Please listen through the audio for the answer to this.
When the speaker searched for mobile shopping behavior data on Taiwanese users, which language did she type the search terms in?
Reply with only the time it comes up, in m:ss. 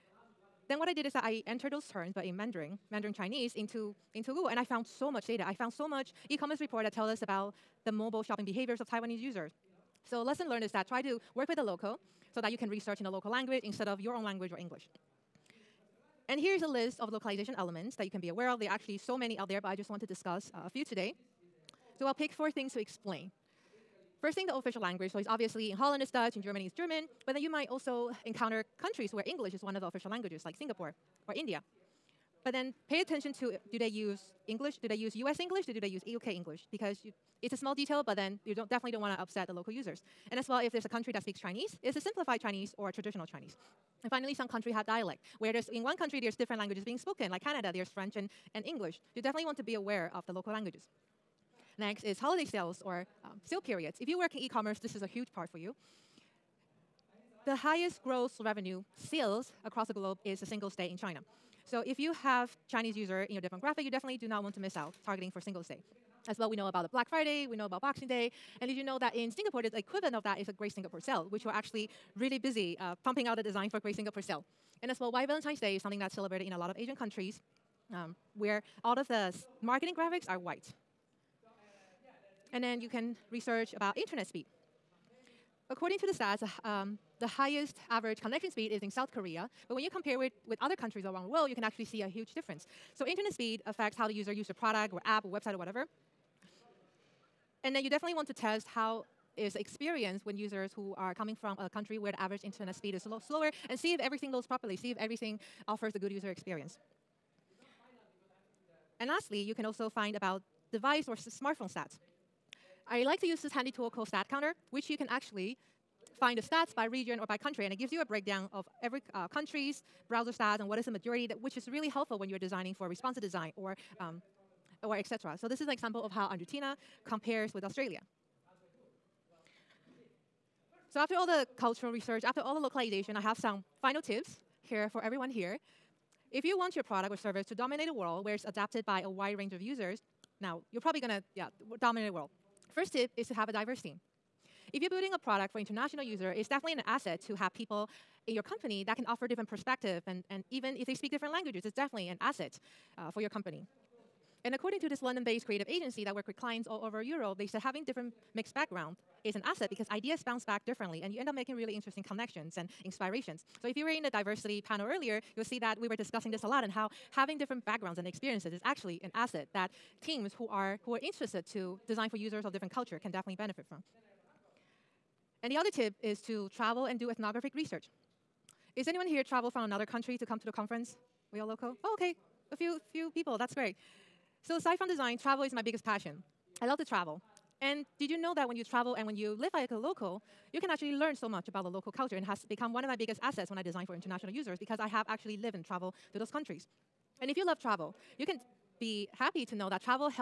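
0:02.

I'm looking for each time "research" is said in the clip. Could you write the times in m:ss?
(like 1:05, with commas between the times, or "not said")
0:12, 1:23, 2:11, 2:57.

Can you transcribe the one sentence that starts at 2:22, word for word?
First tip is to have a diverse team.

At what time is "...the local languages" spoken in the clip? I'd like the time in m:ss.
0:50.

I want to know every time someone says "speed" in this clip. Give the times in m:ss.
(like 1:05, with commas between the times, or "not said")
1:24, 1:28, 1:33, 1:42.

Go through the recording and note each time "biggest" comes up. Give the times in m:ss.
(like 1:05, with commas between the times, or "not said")
3:05, 3:12.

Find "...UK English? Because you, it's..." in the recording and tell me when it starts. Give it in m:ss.
0:36.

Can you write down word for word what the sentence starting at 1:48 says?
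And lastly, you can also find about device or smartphone stats.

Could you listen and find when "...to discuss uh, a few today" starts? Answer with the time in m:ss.
0:20.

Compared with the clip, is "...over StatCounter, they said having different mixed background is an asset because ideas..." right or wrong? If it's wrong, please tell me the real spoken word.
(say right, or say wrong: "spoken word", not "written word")
wrong: "Europe", not "StatCounter".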